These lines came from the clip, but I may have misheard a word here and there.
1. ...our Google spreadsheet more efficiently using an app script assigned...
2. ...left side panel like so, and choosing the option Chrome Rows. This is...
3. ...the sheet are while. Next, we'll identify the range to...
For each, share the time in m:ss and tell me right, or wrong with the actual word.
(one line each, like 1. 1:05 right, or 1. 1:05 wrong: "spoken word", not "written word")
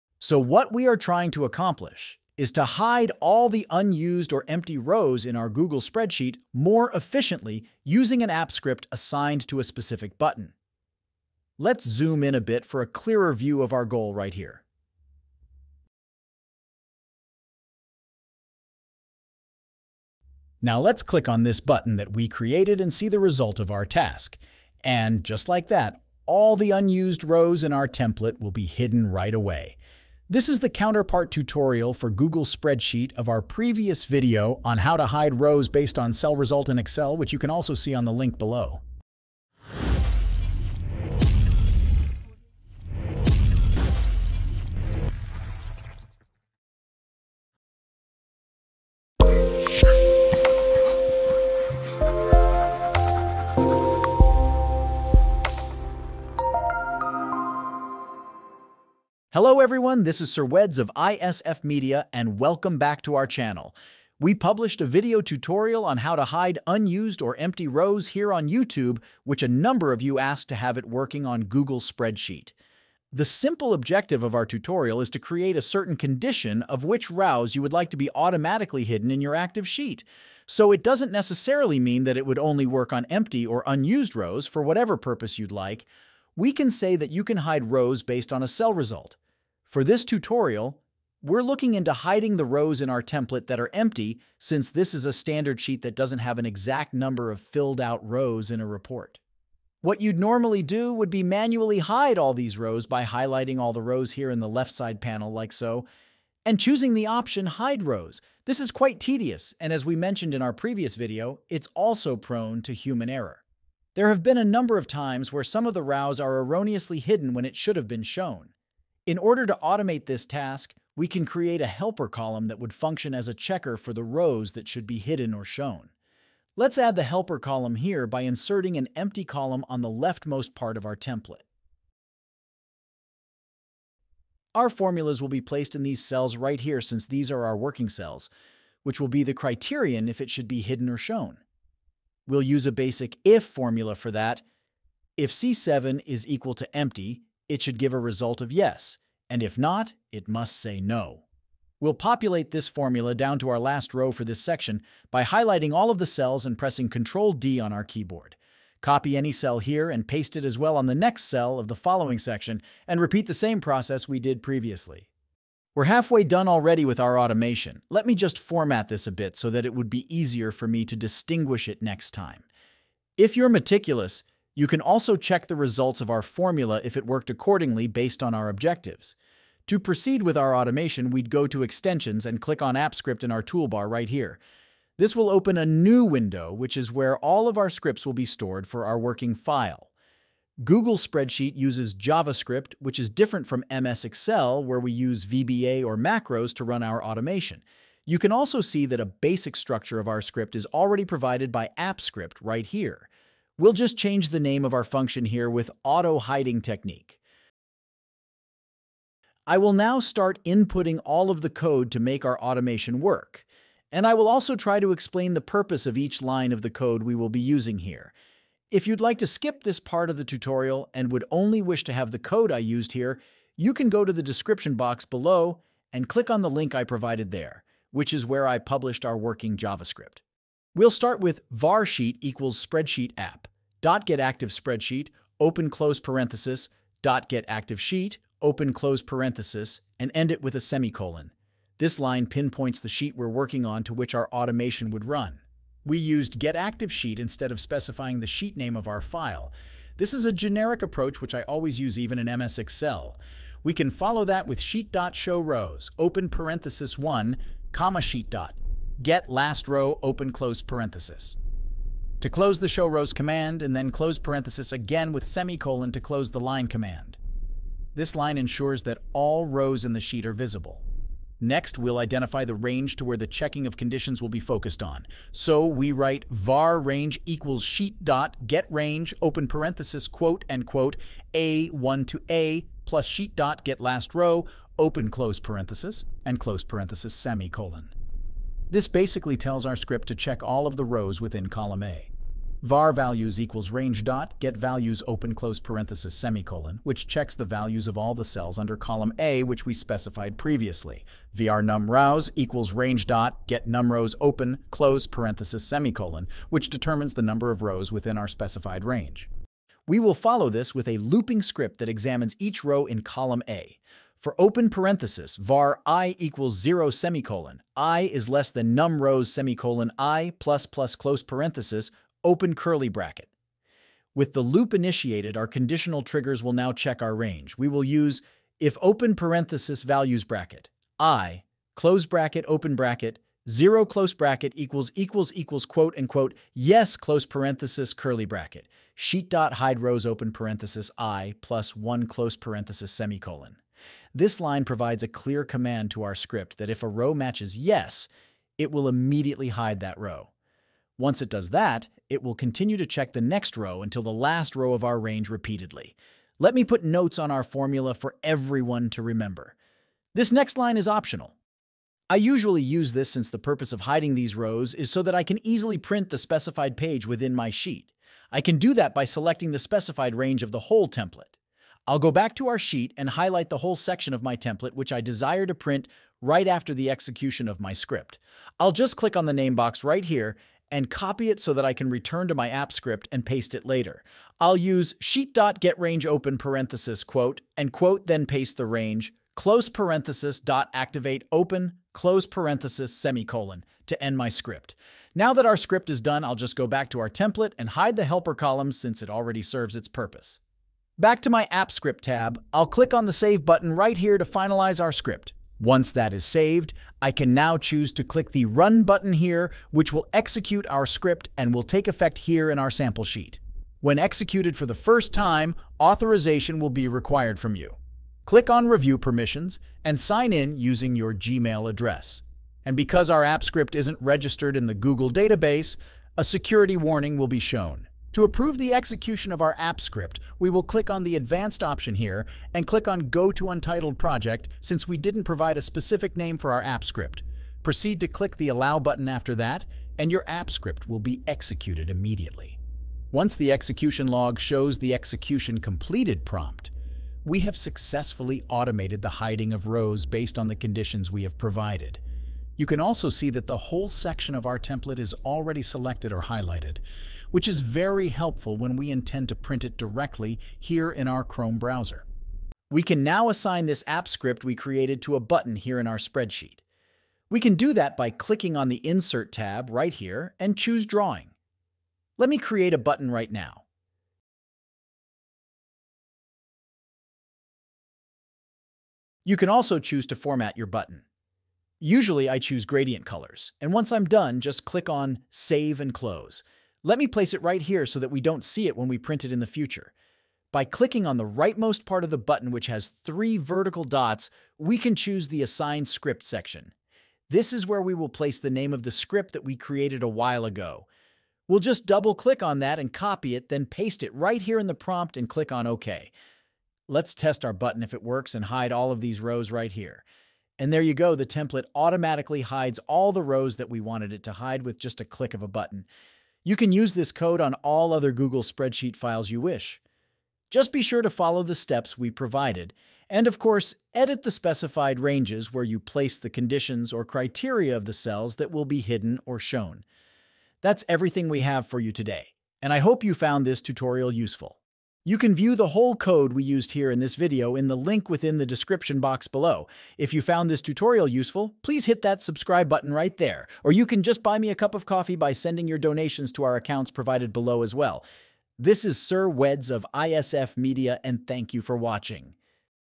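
1. 0:05 right
2. 1:44 wrong: "Hide", not "Chrome"
3. 4:29 wrong: "visible", not "while".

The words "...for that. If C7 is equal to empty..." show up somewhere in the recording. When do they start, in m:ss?
2:23.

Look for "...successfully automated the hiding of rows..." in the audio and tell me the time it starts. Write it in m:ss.
7:27.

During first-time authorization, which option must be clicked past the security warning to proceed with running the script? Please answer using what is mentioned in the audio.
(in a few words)
Go to Untitled Project.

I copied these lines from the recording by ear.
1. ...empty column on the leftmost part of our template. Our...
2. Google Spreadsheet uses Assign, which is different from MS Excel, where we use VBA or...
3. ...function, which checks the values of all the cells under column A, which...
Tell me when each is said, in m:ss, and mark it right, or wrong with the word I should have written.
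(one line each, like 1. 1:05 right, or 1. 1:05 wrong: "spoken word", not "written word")
1. 2:08 right
2. 3:10 wrong: "JavaScript", not "Assign"
3. 4:56 wrong: "semicolon", not "function".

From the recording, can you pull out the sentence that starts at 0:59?
Hello everyone, this is Sir Weds of ISF Media and welcome back to our channel.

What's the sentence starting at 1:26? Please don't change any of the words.
We can say that you can hide rows based on a cell result.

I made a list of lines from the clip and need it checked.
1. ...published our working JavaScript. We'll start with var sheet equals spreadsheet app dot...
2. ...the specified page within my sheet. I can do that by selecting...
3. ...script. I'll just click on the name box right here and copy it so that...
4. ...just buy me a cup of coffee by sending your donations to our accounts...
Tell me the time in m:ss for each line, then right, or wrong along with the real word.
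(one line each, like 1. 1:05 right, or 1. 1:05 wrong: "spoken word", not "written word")
1. 3:48 right
2. 6:06 right
3. 6:17 right
4. 9:04 right.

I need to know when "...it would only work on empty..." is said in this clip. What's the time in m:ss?
1:22.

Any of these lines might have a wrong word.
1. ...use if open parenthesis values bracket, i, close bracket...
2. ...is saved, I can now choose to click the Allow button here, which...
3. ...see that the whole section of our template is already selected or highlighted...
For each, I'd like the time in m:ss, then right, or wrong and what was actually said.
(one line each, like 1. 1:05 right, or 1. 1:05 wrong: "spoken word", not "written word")
1. 5:27 right
2. 6:46 wrong: "Run", not "Allow"
3. 7:33 right.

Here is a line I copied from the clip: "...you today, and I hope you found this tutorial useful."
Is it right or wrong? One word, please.
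right.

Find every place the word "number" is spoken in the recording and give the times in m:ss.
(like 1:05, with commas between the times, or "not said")
1:09, 1:36, 1:54, 5:07.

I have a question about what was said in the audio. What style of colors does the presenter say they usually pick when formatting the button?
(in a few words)
gradient colors.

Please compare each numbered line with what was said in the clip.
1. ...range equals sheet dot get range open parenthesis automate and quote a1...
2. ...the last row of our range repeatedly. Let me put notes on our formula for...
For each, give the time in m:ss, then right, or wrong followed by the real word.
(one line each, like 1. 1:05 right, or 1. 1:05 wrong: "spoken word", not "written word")
1. 4:36 wrong: "quote", not "automate"
2. 5:54 right.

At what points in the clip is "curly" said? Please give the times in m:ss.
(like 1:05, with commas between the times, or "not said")
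5:22, 5:37.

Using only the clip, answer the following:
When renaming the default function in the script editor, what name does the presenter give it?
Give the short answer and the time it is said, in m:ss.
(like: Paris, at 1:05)
auto hiding technique, at 3:25.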